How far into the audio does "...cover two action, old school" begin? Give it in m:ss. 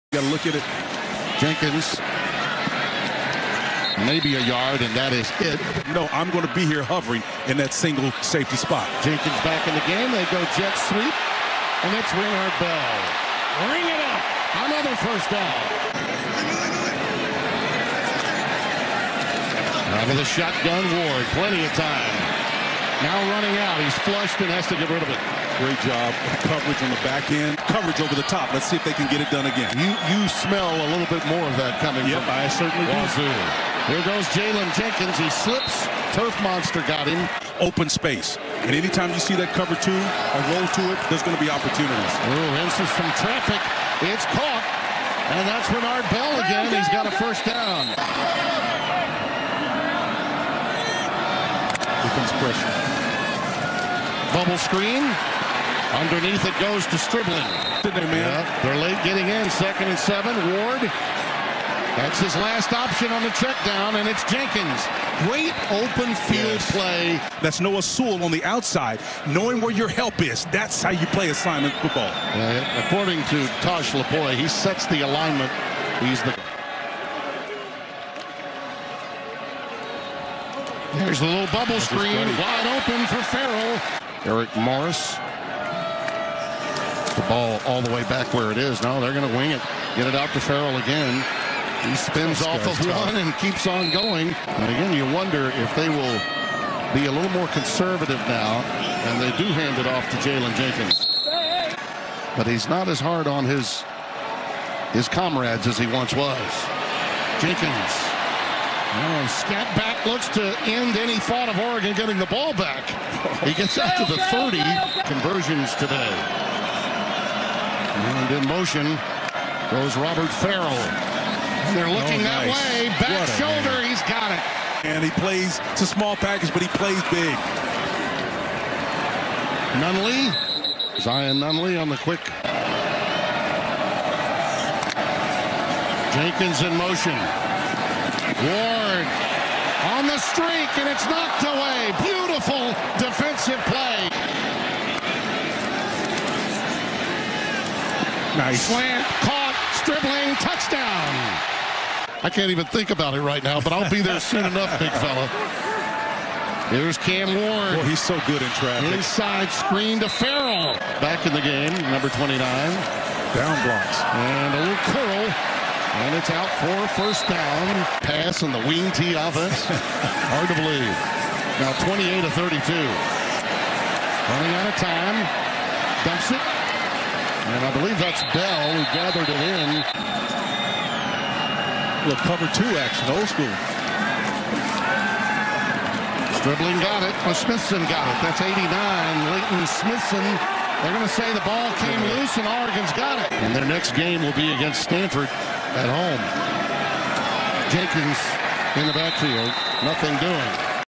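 3:02.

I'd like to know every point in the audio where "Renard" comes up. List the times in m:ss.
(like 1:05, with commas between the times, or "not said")
0:12, 0:45.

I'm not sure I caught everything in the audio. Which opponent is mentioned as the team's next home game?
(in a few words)
Stanford.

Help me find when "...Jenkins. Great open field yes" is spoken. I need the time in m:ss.
1:04.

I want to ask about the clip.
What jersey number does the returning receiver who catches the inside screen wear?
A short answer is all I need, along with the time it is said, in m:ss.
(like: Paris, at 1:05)
29, at 2:41.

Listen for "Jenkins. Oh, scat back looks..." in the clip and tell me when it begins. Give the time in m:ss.
1:47.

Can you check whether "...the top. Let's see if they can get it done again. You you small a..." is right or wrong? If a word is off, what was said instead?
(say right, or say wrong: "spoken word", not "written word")
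wrong: "smell", not "small".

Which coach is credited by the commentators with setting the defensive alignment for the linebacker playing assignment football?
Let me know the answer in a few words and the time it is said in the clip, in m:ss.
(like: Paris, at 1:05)
Tosh Lupoi, at 1:13.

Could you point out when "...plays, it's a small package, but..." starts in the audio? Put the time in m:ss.
2:05.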